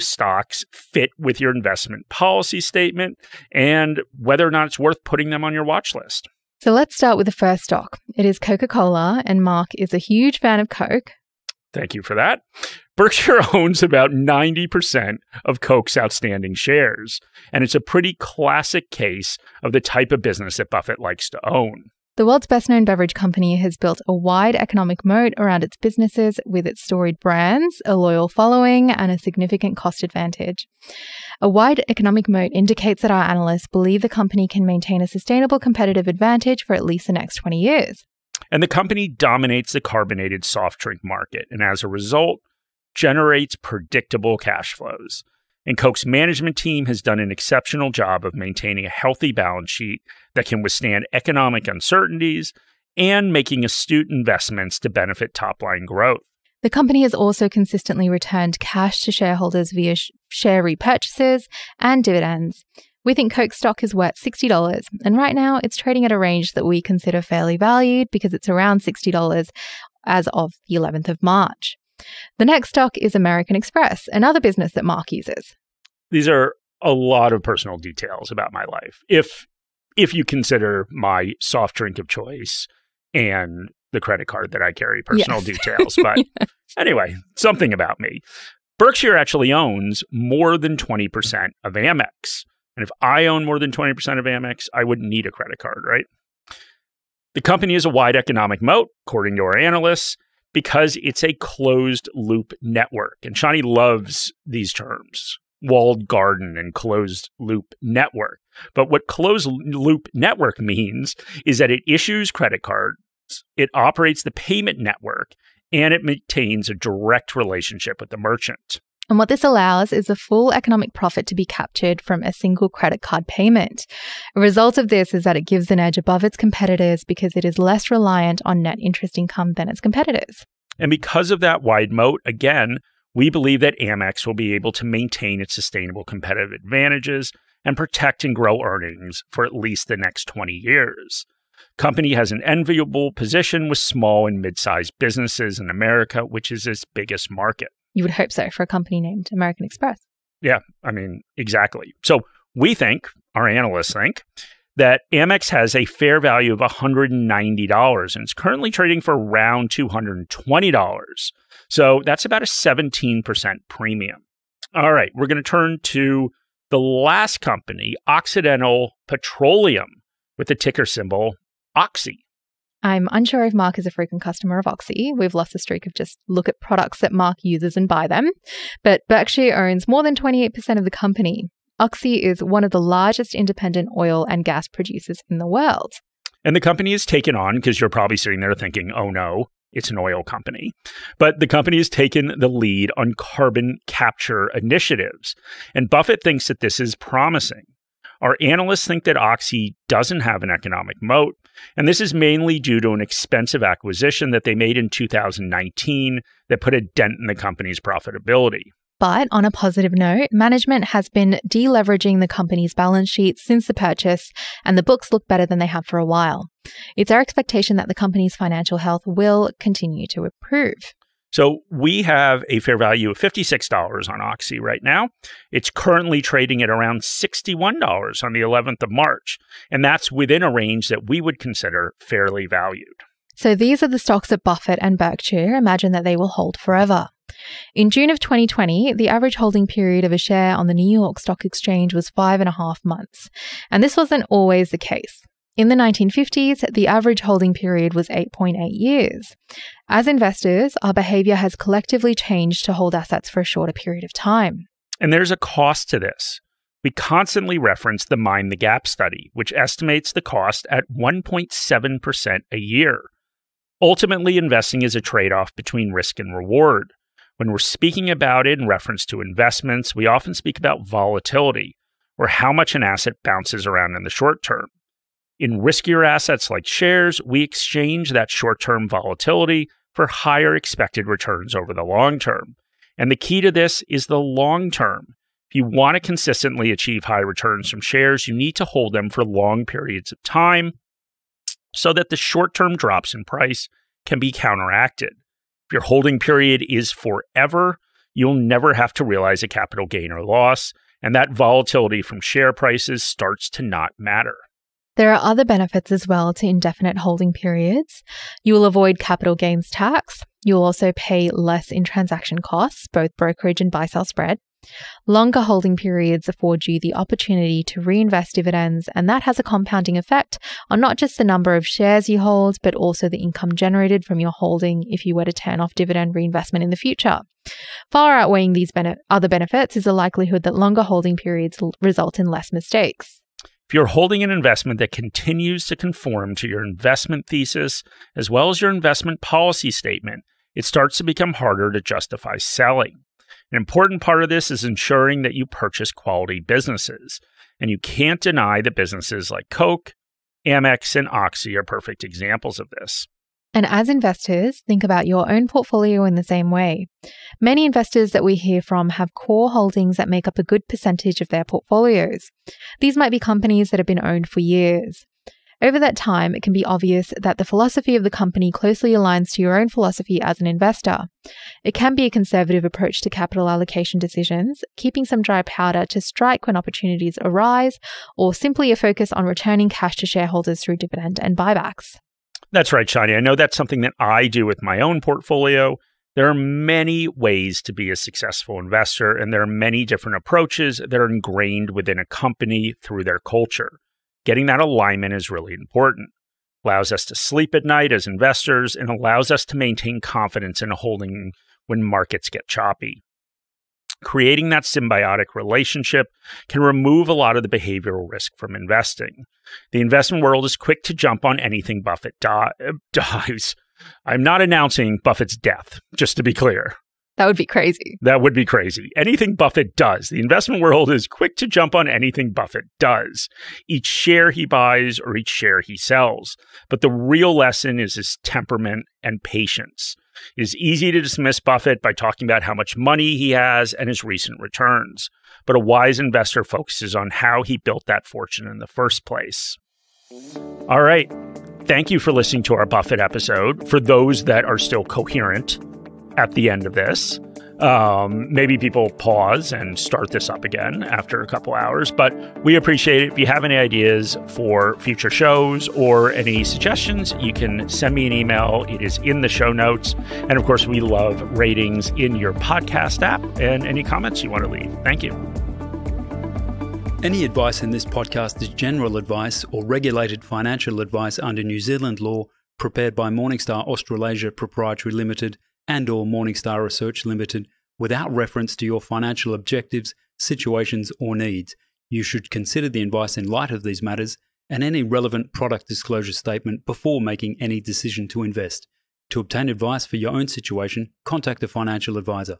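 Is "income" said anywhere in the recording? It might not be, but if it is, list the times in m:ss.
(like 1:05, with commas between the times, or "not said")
2:09, 5:23.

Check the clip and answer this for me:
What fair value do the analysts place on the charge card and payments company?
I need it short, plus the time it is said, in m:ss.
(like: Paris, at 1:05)
$190, at 2:36.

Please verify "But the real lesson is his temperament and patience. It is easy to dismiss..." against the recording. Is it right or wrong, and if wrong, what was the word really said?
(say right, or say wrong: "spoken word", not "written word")
right.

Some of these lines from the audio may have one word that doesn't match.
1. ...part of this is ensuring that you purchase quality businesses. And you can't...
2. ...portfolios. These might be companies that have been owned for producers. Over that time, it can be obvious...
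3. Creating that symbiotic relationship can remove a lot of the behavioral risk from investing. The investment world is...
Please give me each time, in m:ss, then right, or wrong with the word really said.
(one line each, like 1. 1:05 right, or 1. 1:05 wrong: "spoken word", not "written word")
1. 5:44 right
2. 6:01 wrong: "years", not "producers"
3. 6:44 right.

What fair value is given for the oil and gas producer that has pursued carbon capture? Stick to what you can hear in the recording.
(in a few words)
$56.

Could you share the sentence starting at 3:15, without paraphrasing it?
And Buffett thinks that this is promising.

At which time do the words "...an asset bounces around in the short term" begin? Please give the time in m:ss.
4:32.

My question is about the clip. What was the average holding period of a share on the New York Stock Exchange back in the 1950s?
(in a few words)
8.8 years.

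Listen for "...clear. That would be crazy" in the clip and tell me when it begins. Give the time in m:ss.
6:56.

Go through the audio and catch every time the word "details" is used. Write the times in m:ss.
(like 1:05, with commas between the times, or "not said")
1:17, 1:25.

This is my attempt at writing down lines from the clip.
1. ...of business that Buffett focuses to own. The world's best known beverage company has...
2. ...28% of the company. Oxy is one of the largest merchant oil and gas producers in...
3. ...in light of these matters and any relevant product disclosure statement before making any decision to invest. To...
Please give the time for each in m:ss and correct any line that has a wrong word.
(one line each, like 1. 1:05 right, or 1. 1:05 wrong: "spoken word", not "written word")
1. 0:20 wrong: "likes", not "focuses"
2. 3:00 wrong: "independent", not "merchant"
3. 8:03 right.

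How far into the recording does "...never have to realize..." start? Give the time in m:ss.
4:58.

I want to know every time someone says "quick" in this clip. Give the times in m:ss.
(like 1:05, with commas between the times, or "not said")
6:50, 7:01.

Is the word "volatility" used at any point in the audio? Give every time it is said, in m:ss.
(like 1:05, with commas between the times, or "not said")
4:30, 4:38, 5:01.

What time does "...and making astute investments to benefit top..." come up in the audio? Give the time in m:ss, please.
0:52.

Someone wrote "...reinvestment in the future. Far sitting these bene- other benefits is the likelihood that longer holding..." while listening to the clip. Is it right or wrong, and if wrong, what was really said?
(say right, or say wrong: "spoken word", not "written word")
wrong: "outweighing", not "sitting".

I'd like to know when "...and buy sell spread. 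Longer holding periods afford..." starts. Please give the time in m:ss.
5:13.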